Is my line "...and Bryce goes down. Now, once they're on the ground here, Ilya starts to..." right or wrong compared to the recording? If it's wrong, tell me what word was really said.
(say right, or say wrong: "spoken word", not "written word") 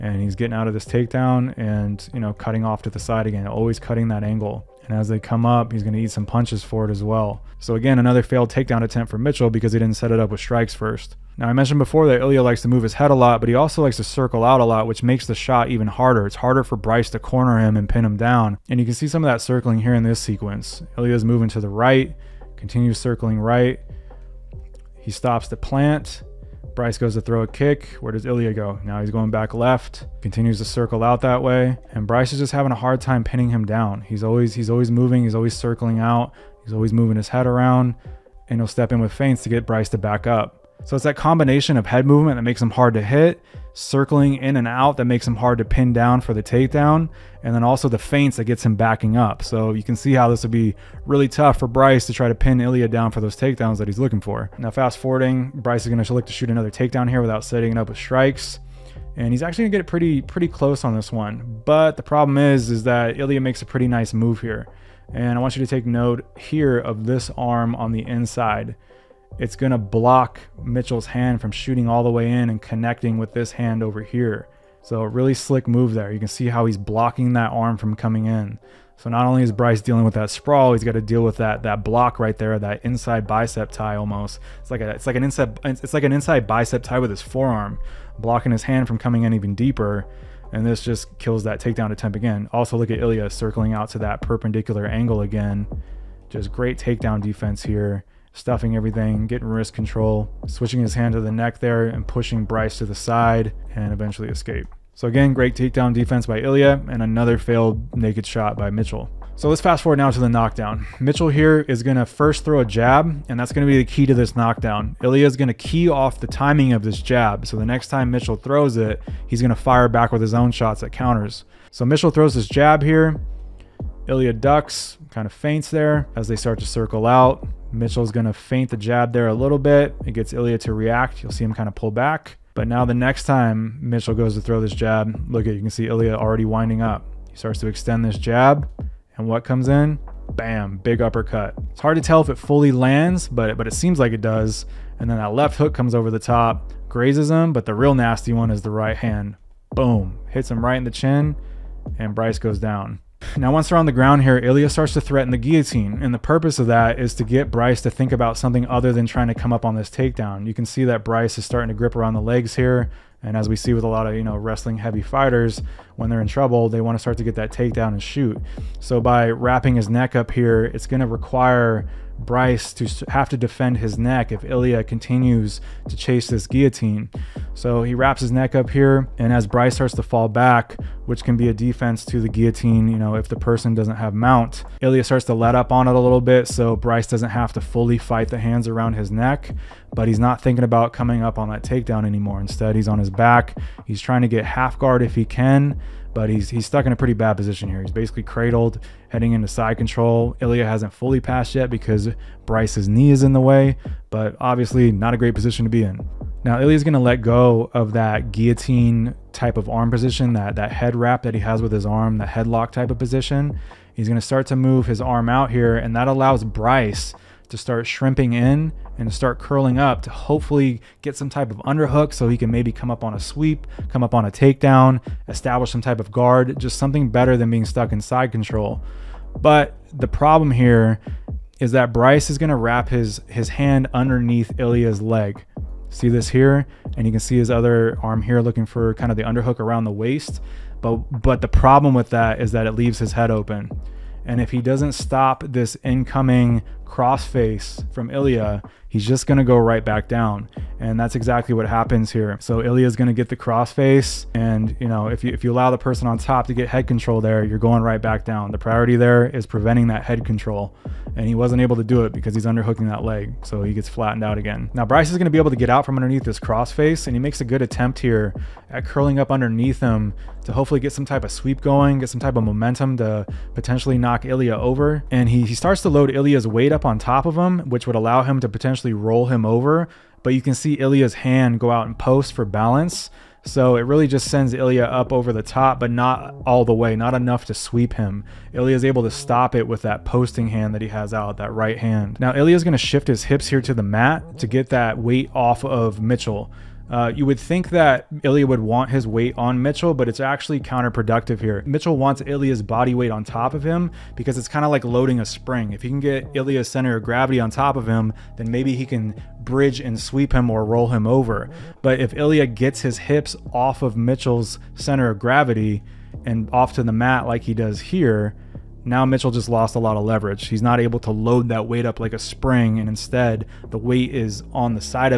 right.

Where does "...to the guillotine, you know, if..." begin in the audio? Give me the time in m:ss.
3:02.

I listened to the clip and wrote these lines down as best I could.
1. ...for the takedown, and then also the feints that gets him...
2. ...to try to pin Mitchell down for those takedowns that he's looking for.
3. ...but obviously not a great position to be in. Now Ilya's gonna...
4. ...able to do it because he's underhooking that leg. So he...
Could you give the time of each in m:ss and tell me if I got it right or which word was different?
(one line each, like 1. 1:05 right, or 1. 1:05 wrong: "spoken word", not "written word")
1. 0:46 right
2. 0:52 wrong: "Ilya", not "Mitchell"
3. 3:24 right
4. 4:21 right.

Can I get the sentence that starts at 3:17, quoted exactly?
He's basically cradled, heading into side control.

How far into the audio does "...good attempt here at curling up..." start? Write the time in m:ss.
4:27.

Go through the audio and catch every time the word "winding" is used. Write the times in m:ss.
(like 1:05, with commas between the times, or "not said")
2:16.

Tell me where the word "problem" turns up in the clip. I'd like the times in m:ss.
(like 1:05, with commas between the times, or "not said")
1:02, 3:50, 4:01.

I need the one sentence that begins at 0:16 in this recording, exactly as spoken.
It's harder for Bryce to corner him and pin him down.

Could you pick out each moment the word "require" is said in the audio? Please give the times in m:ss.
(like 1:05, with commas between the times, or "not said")
2:51.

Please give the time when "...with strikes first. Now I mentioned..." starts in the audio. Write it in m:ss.
0:10.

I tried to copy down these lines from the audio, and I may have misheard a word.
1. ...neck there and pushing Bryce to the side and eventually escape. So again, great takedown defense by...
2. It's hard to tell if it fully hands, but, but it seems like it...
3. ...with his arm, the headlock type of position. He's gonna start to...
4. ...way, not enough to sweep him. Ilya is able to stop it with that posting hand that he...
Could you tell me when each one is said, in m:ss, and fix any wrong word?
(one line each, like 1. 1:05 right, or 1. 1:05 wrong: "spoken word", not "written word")
1. 1:41 right
2. 2:21 wrong: "lands", not "hands"
3. 3:31 right
4. 4:46 right.